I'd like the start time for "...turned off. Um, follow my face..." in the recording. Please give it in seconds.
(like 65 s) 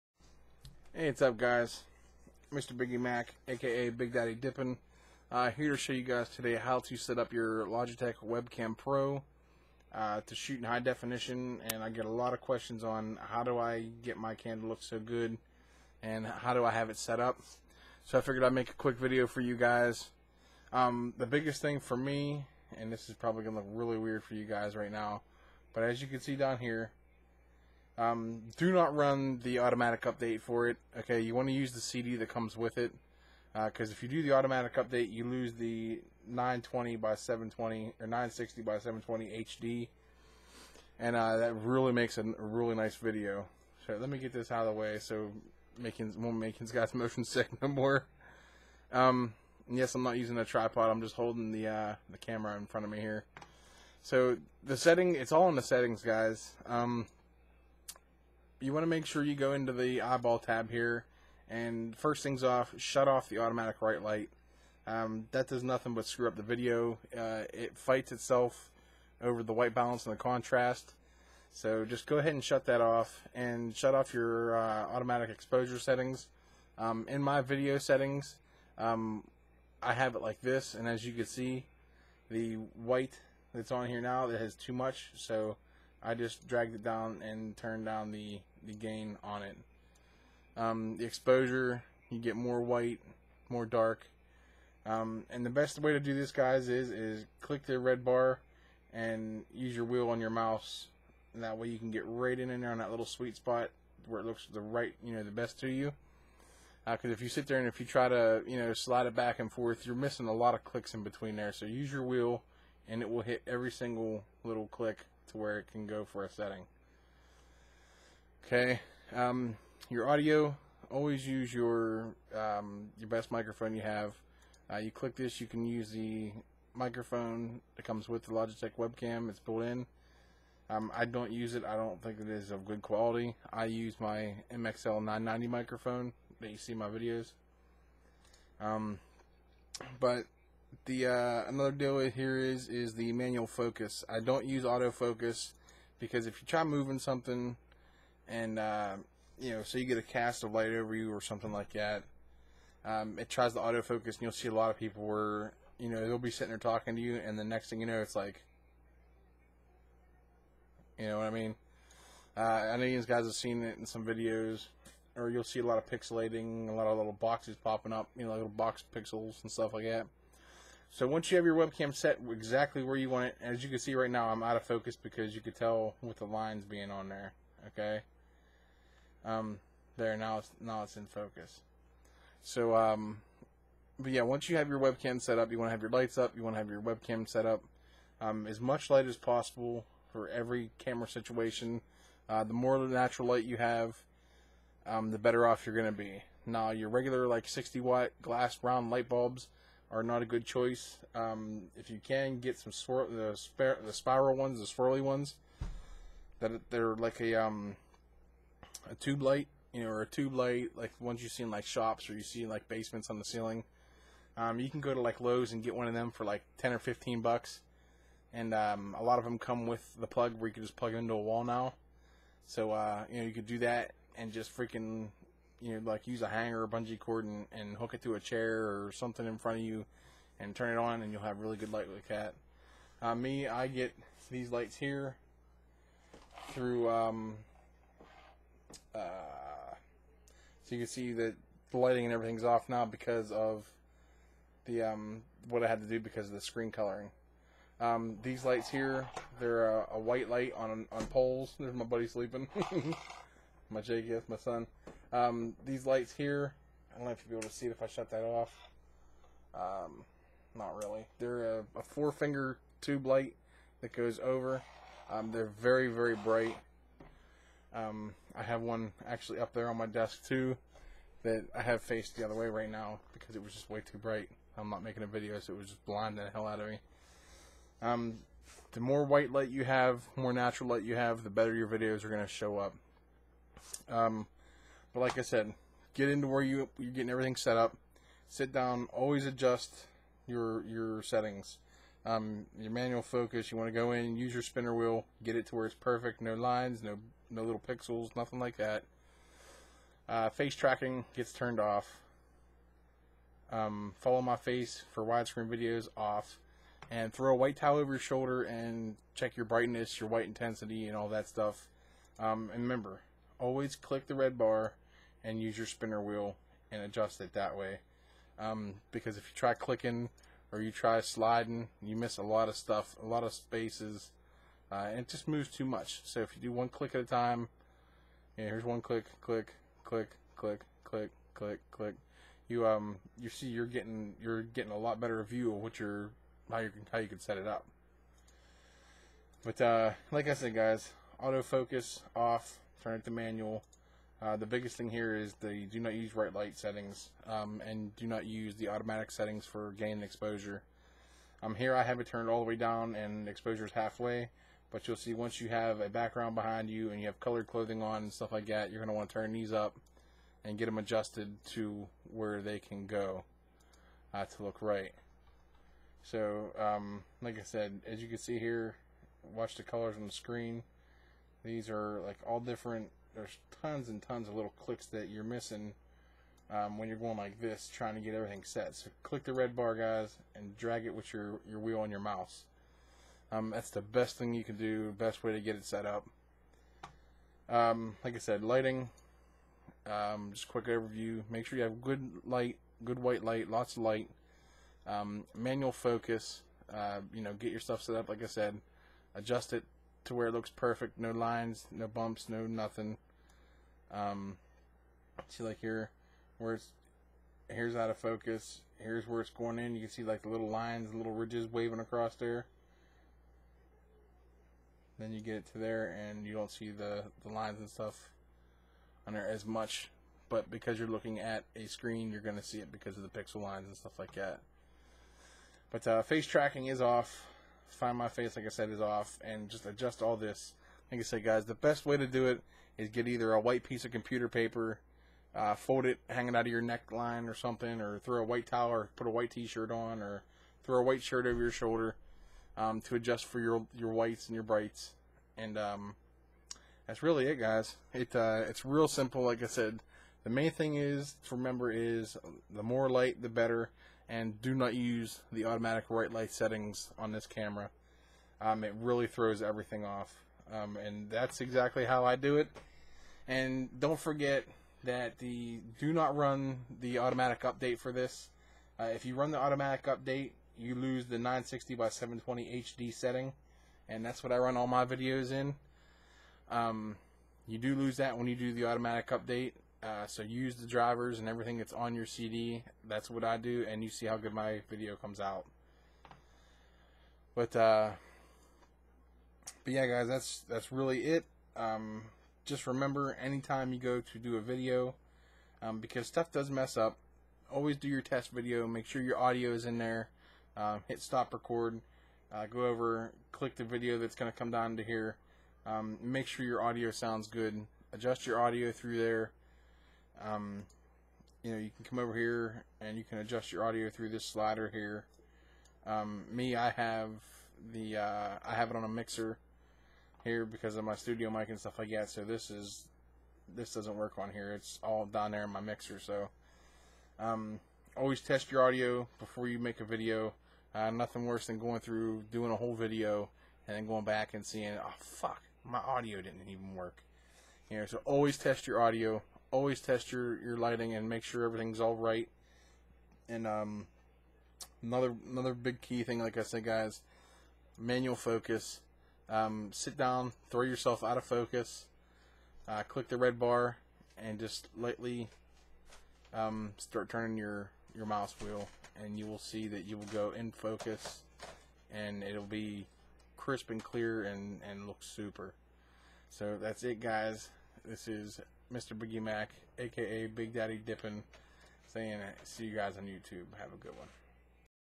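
301 s.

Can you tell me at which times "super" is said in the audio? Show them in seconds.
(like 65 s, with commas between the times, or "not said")
565 s.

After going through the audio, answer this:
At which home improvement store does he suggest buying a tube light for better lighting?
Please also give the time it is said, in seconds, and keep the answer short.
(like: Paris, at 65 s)
Lowe's, at 215 s.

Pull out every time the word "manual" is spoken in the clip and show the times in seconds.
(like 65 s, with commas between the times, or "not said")
143 s, 292 s, 343 s, 395 s, 547 s.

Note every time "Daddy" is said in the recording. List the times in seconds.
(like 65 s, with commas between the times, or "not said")
4 s, 570 s.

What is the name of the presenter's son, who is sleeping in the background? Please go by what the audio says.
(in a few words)
Jakey.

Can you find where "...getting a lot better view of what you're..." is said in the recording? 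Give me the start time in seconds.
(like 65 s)
334 s.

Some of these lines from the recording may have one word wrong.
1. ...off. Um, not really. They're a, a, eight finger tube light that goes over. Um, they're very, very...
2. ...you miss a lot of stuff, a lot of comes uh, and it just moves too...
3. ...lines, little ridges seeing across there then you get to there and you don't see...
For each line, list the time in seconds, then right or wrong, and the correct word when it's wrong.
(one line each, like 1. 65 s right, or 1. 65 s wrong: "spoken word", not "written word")
1. 258 s wrong: "four", not "eight"
2. 321 s wrong: "spaces", not "comes"
3. 410 s wrong: "waving", not "seeing".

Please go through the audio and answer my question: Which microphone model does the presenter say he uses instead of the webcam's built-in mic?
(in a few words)
MXL 990.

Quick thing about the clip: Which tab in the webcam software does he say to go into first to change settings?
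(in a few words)
The eyeball tab.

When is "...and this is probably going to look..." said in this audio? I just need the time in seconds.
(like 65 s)
22 s.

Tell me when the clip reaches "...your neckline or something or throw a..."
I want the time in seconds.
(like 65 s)
436 s.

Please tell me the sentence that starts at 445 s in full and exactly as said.
And um, that's really it, guys.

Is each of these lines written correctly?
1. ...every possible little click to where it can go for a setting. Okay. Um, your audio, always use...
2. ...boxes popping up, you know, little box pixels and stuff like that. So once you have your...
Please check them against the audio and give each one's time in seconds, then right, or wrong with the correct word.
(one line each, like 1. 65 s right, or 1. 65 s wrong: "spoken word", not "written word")
1. 113 s wrong: "single", not "possible"
2. 167 s right.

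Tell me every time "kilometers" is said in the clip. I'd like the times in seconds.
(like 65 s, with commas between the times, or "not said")
not said.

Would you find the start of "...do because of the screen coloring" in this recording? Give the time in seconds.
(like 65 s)
245 s.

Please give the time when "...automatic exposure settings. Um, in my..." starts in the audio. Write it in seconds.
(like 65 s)
74 s.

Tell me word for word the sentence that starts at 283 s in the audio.
Um, but like I said, get into where you you're getting everything set up.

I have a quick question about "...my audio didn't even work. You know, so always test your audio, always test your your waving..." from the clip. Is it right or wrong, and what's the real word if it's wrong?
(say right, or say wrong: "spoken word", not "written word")
wrong: "lighting", not "waving".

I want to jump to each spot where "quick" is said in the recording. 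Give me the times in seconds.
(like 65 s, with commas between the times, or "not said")
18 s, 390 s.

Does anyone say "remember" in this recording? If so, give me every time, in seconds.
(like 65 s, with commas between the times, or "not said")
312 s, 451 s, 492 s.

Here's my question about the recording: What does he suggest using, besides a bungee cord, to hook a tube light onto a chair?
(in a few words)
A hanger.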